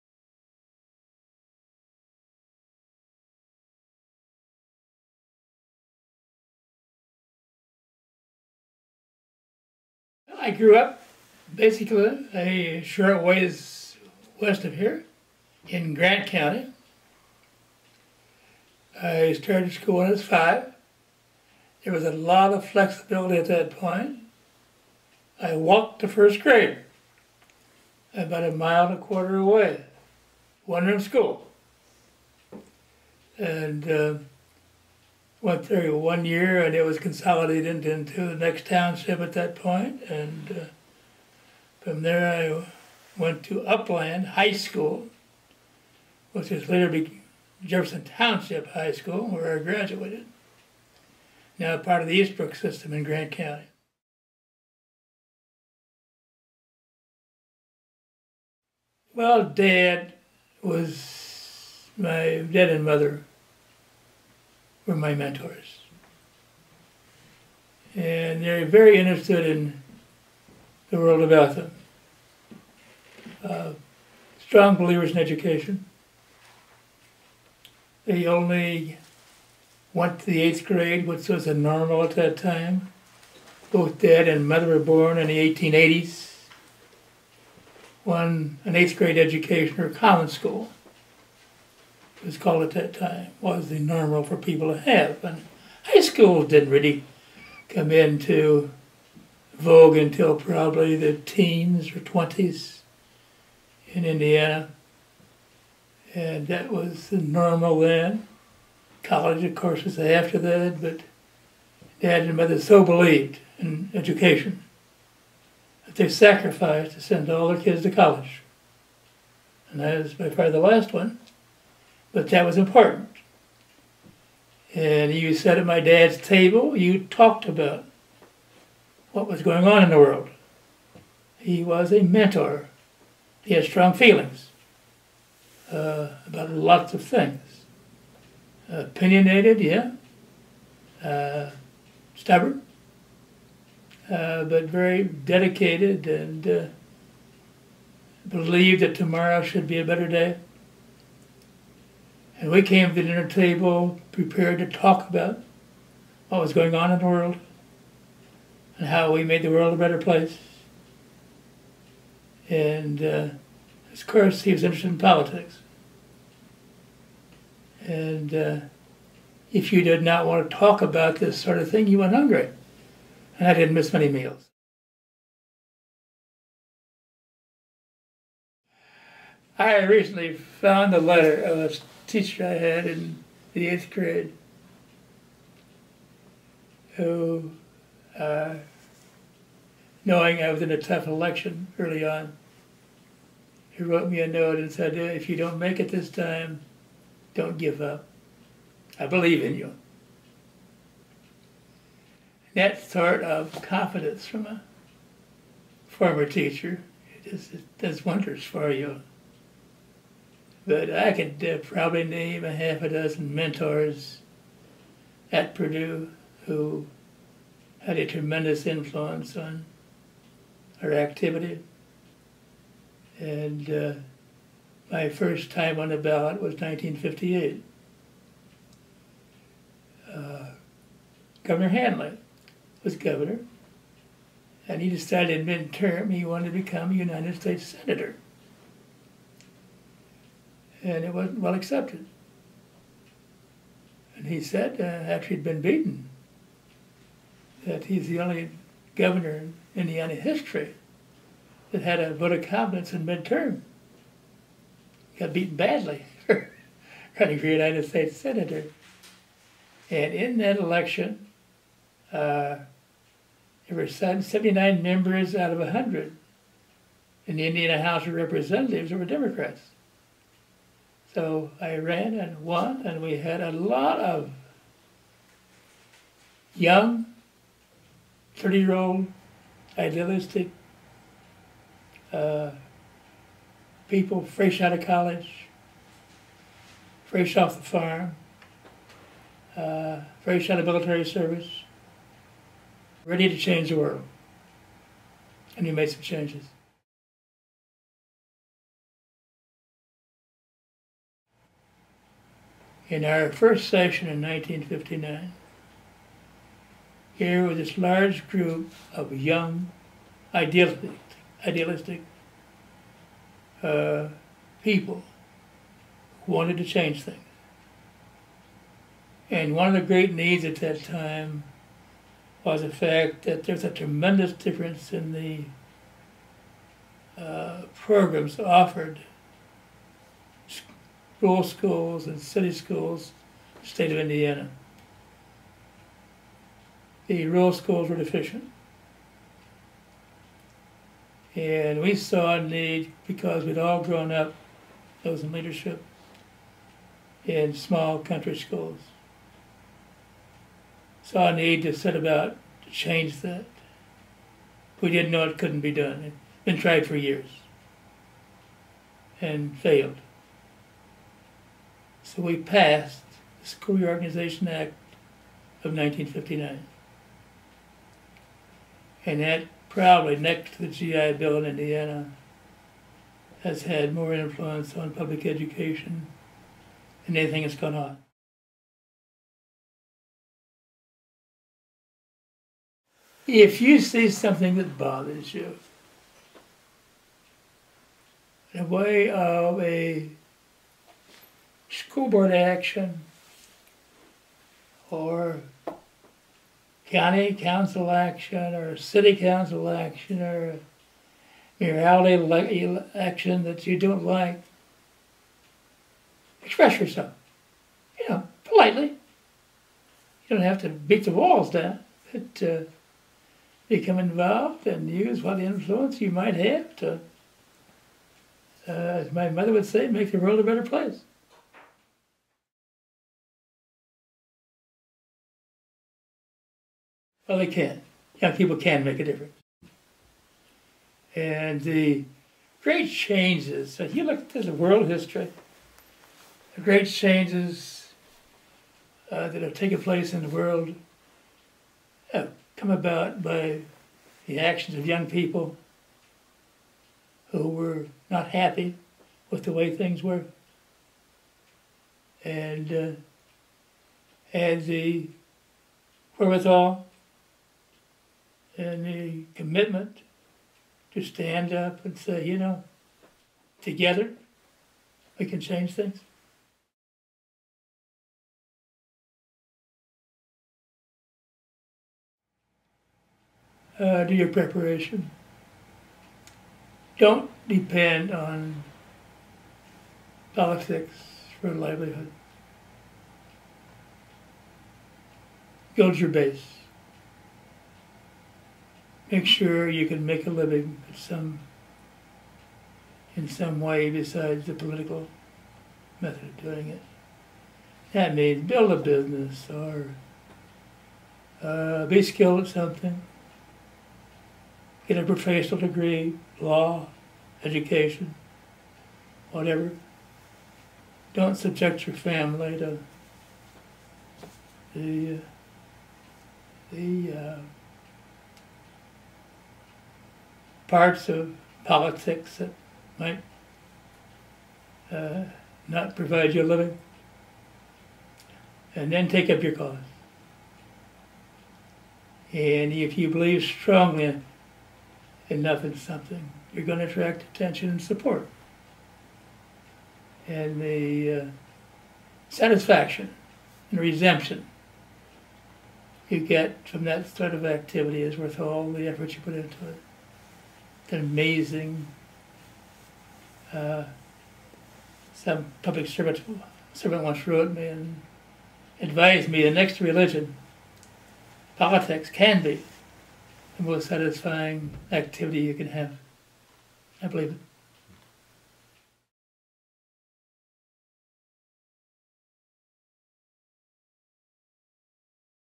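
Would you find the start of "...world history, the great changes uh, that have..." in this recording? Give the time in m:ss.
7:14.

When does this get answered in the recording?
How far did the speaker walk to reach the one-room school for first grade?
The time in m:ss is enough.
0:28.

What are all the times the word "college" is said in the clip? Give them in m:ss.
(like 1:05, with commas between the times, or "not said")
1:49, 1:57, 4:44.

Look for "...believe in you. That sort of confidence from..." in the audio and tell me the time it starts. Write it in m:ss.
3:19.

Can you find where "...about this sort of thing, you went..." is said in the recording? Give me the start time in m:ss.
2:50.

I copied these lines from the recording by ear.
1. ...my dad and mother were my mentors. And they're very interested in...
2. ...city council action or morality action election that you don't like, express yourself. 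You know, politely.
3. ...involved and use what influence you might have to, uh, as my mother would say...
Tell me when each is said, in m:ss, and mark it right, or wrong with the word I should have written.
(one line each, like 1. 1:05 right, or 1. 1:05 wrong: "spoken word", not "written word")
1. 1:01 right
2. 6:38 right
3. 6:53 right.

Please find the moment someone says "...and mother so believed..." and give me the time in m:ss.
1:52.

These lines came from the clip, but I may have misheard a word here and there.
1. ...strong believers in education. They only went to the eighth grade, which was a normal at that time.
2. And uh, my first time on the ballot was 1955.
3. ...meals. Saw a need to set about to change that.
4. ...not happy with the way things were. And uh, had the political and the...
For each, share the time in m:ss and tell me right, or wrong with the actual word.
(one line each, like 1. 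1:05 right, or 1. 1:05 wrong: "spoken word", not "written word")
1. 1:14 right
2. 3:43 wrong: "1958", not "1955"
3. 5:48 wrong: "schools", not "meals"
4. 7:28 wrong: "wherewithal", not "political".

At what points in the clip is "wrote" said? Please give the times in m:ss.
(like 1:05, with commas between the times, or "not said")
3:13, 9:17.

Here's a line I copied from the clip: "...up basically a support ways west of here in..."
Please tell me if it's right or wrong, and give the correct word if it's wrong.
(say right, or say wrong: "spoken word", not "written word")
wrong: "short", not "support".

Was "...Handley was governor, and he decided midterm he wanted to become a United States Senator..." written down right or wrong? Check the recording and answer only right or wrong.
right.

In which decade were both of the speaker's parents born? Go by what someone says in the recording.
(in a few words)
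1880s.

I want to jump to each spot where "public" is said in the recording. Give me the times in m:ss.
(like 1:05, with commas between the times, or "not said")
6:14, 9:15.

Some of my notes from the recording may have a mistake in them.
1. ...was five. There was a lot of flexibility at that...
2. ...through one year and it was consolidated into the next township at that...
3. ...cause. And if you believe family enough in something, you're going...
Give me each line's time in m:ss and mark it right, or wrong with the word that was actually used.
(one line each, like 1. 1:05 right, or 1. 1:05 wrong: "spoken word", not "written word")
1. 0:20 right
2. 0:35 right
3. 8:49 wrong: "strongly", not "family".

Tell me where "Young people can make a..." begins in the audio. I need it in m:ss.
7:08.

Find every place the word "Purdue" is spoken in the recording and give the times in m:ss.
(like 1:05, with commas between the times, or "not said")
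3:35.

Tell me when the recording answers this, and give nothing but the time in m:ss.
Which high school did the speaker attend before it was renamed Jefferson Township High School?
0:43.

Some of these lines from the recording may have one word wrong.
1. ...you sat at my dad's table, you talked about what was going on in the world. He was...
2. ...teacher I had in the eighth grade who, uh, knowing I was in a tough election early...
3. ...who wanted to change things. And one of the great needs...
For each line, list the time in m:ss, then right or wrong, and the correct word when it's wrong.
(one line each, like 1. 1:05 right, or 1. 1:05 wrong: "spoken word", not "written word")
1. 2:05 right
2. 3:02 right
3. 5:16 right.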